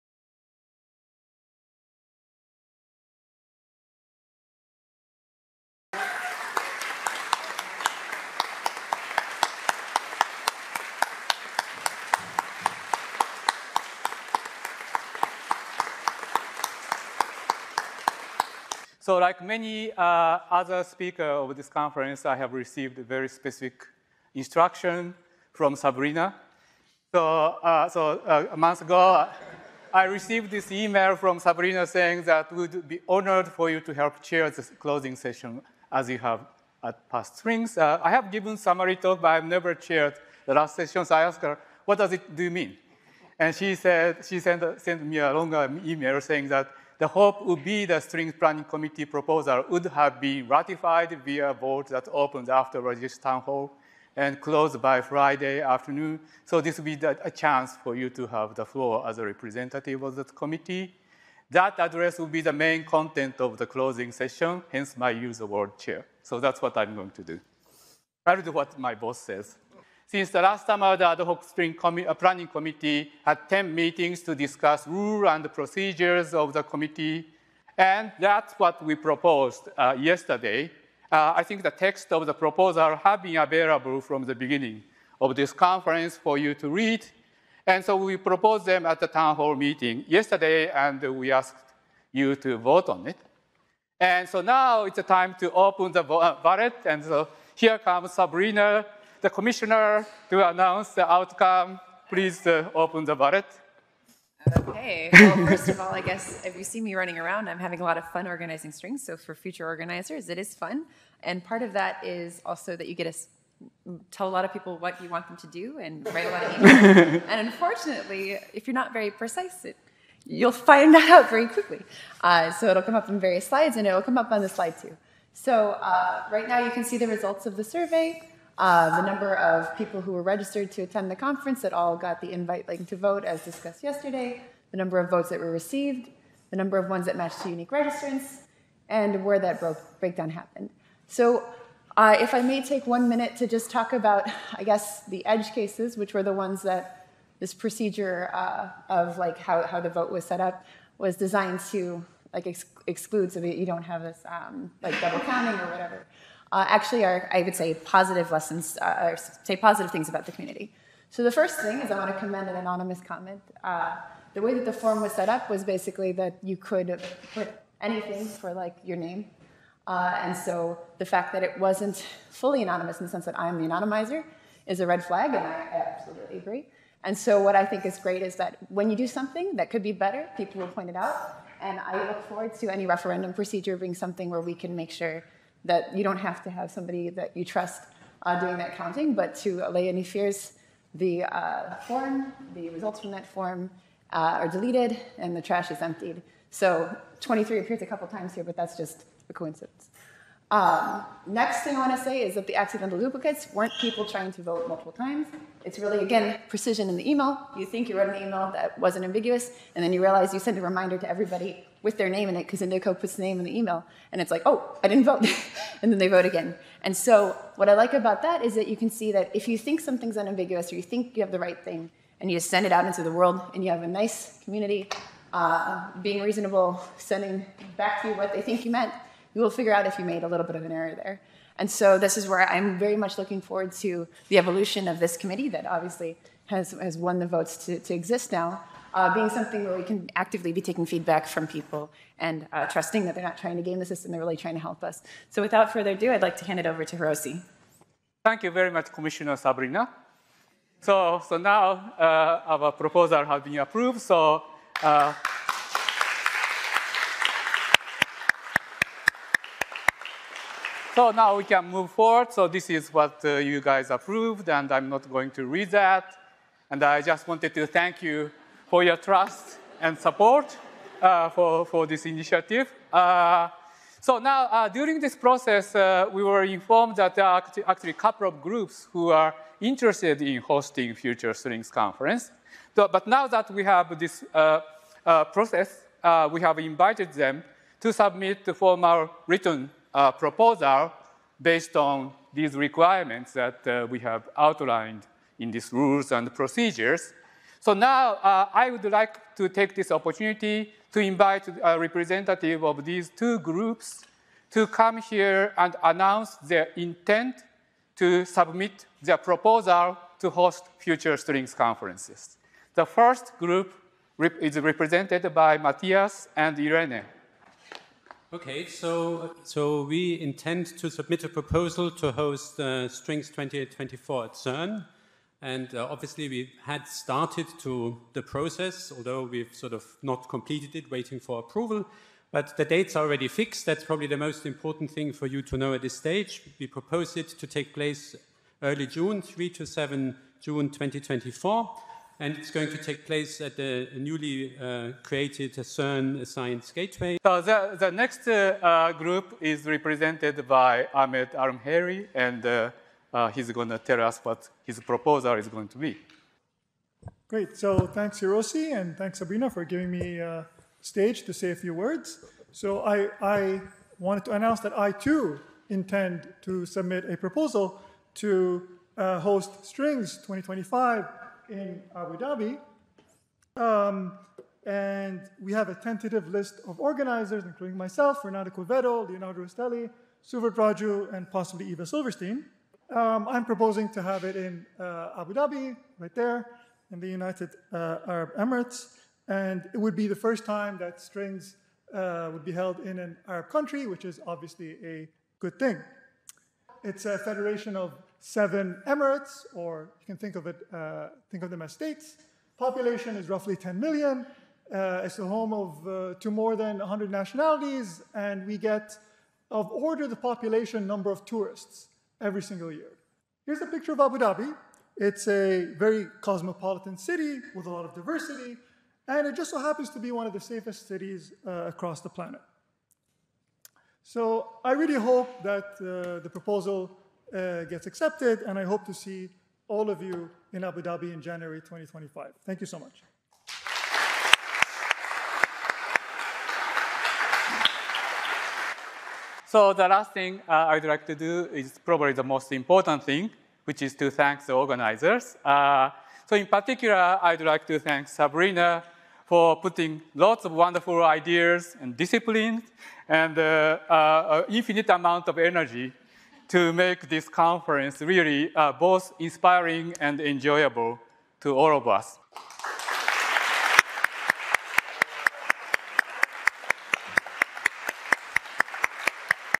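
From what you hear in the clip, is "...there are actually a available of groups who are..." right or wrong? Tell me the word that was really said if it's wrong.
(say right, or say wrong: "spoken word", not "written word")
wrong: "couple", not "available".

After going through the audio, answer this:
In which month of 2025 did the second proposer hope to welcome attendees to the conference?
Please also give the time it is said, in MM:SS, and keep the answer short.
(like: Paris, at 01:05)
January, at 07:11.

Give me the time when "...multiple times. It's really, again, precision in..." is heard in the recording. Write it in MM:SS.
03:24.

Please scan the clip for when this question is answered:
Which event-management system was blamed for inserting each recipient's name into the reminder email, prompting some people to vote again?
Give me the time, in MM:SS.
03:32.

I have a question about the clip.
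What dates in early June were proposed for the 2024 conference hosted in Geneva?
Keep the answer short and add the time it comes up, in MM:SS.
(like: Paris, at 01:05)
3 to 7 June 2024, at 05:39.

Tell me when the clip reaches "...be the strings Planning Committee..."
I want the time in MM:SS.
00:47.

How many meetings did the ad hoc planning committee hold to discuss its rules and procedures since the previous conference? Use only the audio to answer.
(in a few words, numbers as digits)
10.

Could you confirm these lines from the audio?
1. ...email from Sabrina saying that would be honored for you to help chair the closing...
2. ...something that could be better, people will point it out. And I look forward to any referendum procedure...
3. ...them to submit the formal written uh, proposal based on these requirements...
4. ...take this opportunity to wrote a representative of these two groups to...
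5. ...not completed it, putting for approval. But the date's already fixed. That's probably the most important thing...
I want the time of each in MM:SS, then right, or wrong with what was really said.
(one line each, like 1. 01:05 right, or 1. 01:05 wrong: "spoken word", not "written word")
1. 00:30 right
2. 02:59 right
3. 04:47 right
4. 04:59 wrong: "invite", not "wrote"
5. 05:30 wrong: "waiting", not "putting".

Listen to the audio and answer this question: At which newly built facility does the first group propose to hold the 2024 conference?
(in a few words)
CERN Science Gateway.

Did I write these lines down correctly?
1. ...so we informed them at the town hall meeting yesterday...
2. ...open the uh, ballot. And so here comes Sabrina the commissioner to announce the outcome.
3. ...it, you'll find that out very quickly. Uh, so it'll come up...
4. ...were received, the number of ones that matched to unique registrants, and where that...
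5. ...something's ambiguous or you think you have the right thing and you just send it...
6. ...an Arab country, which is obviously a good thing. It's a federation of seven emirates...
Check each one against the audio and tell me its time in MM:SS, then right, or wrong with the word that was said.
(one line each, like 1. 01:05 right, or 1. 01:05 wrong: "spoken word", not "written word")
1. 01:27 wrong: "proposed", not "informed"
2. 01:35 right
3. 01:59 right
4. 02:15 right
5. 03:39 wrong: "unambiguous", not "ambiguous"
6. 06:32 right.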